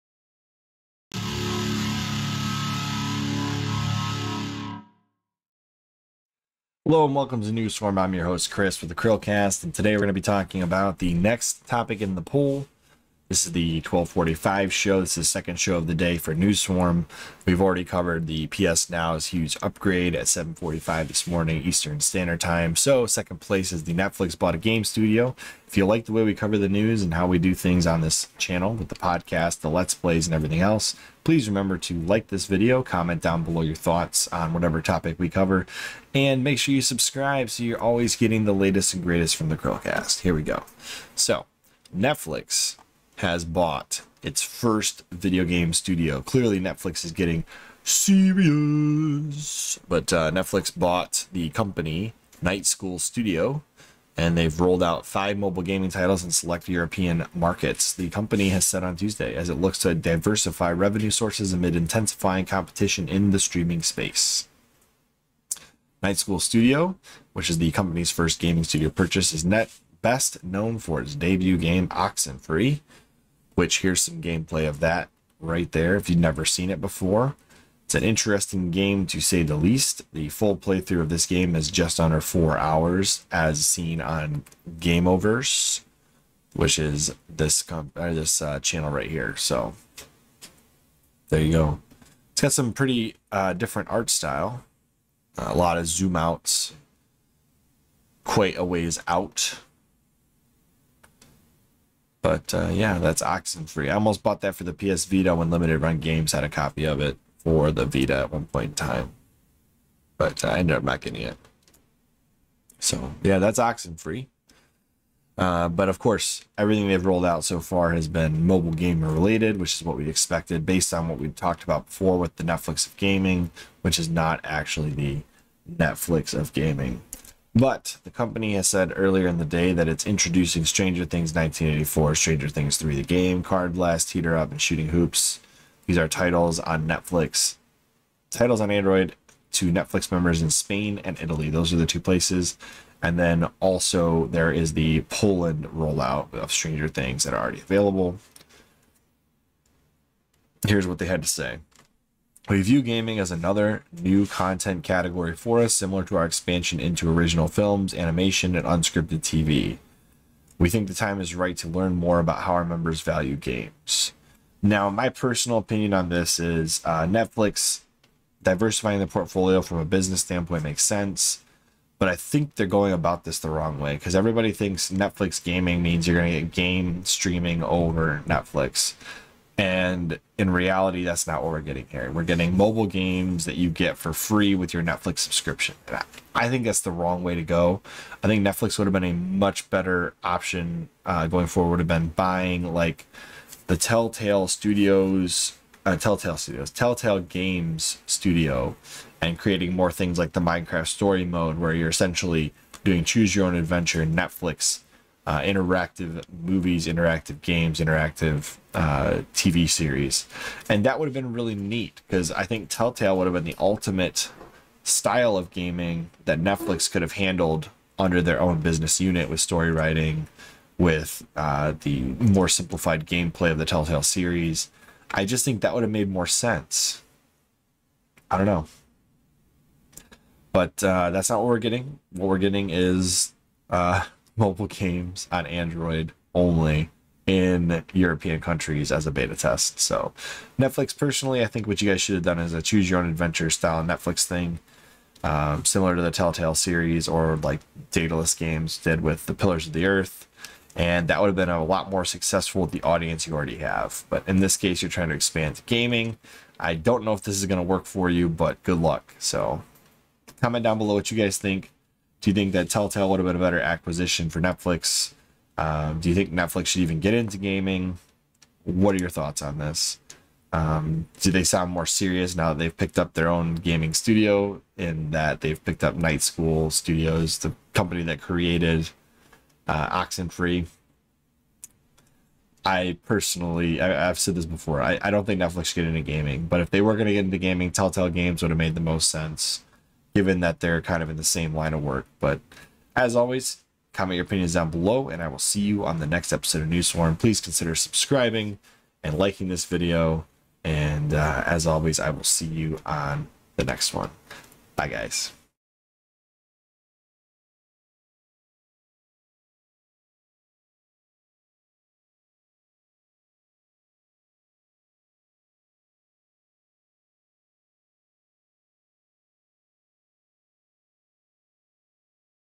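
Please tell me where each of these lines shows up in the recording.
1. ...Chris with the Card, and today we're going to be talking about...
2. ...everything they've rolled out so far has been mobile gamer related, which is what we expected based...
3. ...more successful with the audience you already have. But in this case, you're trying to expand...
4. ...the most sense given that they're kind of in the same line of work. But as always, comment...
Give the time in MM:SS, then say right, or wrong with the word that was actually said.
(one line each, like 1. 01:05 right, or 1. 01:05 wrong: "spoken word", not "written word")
1. 00:08 wrong: "CHRILLCAST", not "Card"
2. 01:56 right
3. 04:11 right
4. 04:48 right.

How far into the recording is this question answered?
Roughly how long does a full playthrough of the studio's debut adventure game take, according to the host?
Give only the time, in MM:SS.
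01:21.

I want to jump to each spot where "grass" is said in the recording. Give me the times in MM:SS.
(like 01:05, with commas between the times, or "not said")
not said.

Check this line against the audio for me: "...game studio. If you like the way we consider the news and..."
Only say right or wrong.
wrong.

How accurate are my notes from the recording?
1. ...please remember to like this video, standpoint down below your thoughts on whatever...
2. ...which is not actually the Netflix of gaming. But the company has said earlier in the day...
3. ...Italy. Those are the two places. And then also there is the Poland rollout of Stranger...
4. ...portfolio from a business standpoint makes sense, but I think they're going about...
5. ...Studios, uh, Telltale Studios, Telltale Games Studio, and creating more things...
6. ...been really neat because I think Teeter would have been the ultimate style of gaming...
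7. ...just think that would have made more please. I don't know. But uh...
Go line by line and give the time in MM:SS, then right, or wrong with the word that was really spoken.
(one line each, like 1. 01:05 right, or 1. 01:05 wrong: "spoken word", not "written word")
1. 00:31 wrong: "comment", not "standpoint"
2. 02:03 right
3. 02:21 right
4. 02:49 right
5. 03:14 right
6. 03:31 wrong: "Telltale", not "Teeter"
7. 03:45 wrong: "sense", not "please".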